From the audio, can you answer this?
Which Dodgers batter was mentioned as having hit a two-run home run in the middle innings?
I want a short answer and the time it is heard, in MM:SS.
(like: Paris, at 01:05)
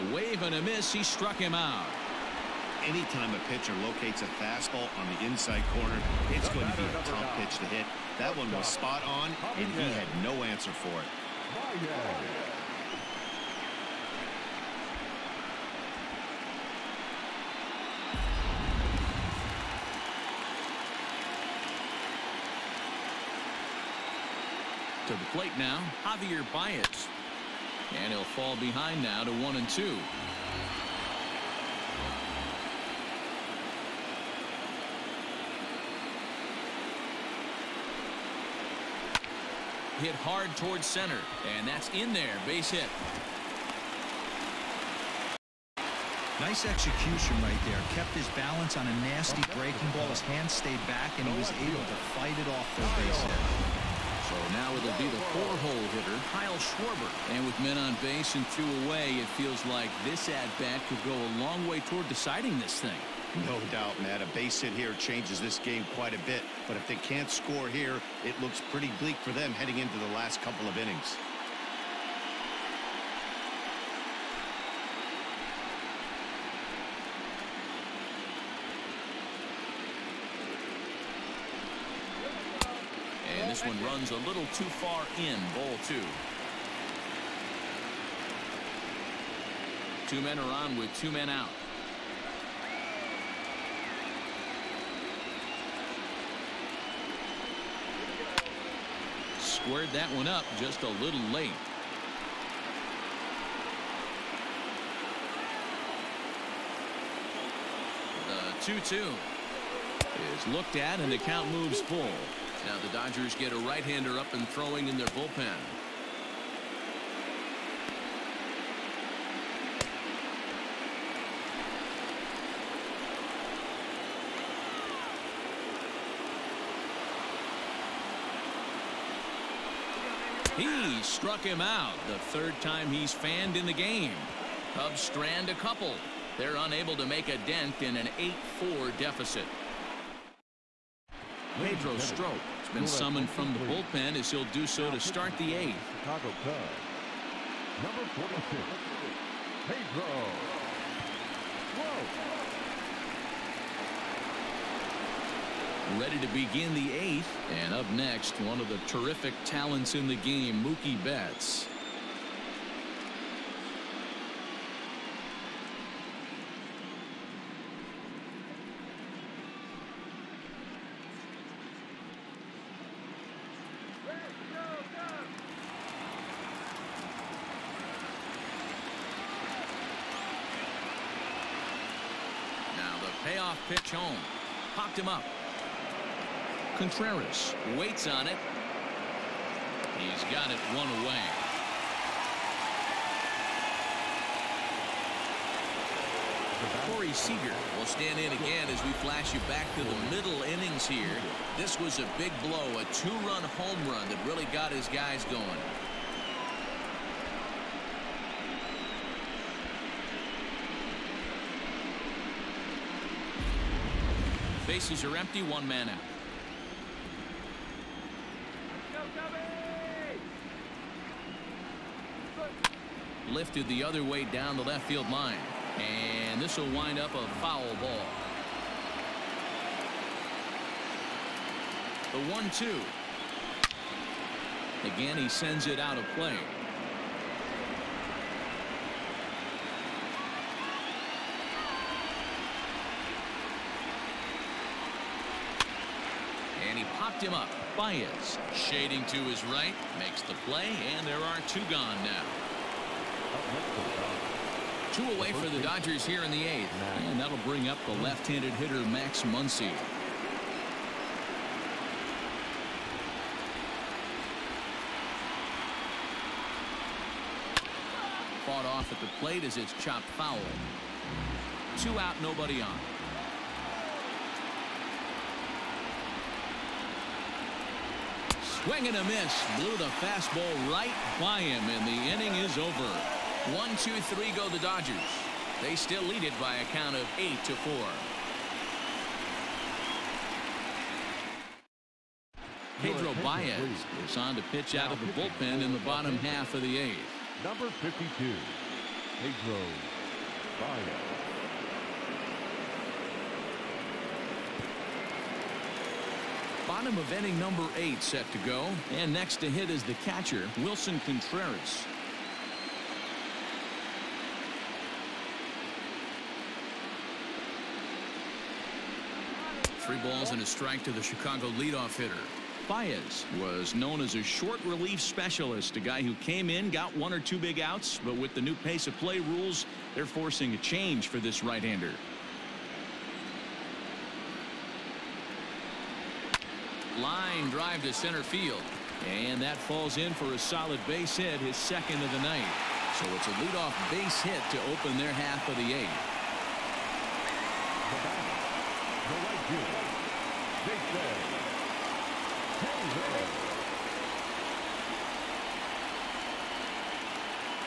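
Corey Seager, at 03:16.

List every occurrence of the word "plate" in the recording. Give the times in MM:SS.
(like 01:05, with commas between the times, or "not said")
00:25, 04:29.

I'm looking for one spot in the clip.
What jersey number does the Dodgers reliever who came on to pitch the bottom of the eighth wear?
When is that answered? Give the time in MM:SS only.
04:57.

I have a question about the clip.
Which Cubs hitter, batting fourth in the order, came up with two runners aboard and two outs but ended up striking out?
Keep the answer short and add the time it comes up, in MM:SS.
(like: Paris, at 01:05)
Kyle Schwarber, at 00:56.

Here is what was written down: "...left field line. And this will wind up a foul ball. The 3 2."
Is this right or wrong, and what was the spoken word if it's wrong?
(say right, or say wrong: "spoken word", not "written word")
wrong: "1", not "3".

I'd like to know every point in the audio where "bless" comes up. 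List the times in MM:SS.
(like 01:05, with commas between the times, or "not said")
not said.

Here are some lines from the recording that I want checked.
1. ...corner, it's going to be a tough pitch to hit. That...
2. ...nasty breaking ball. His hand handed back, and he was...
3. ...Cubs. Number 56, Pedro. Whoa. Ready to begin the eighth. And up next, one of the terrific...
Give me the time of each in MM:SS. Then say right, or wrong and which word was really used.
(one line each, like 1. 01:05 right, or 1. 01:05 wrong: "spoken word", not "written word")
1. 00:05 right
2. 00:49 wrong: "stayed", not "handed"
3. 02:26 wrong: "46", not "56".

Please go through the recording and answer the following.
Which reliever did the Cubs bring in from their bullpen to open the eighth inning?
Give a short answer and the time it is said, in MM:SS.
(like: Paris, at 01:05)
Pedro Strop, at 02:21.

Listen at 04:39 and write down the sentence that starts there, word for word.
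Blew the fastball right by him, and the inning is over.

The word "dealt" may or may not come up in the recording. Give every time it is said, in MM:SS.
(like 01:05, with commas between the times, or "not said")
not said.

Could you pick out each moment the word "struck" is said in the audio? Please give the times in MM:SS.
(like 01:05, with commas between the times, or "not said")
00:01, 02:11.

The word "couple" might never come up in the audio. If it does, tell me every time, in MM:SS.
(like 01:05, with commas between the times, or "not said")
01:10, 02:15.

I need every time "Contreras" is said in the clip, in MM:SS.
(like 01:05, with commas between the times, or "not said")
03:06, 05:11.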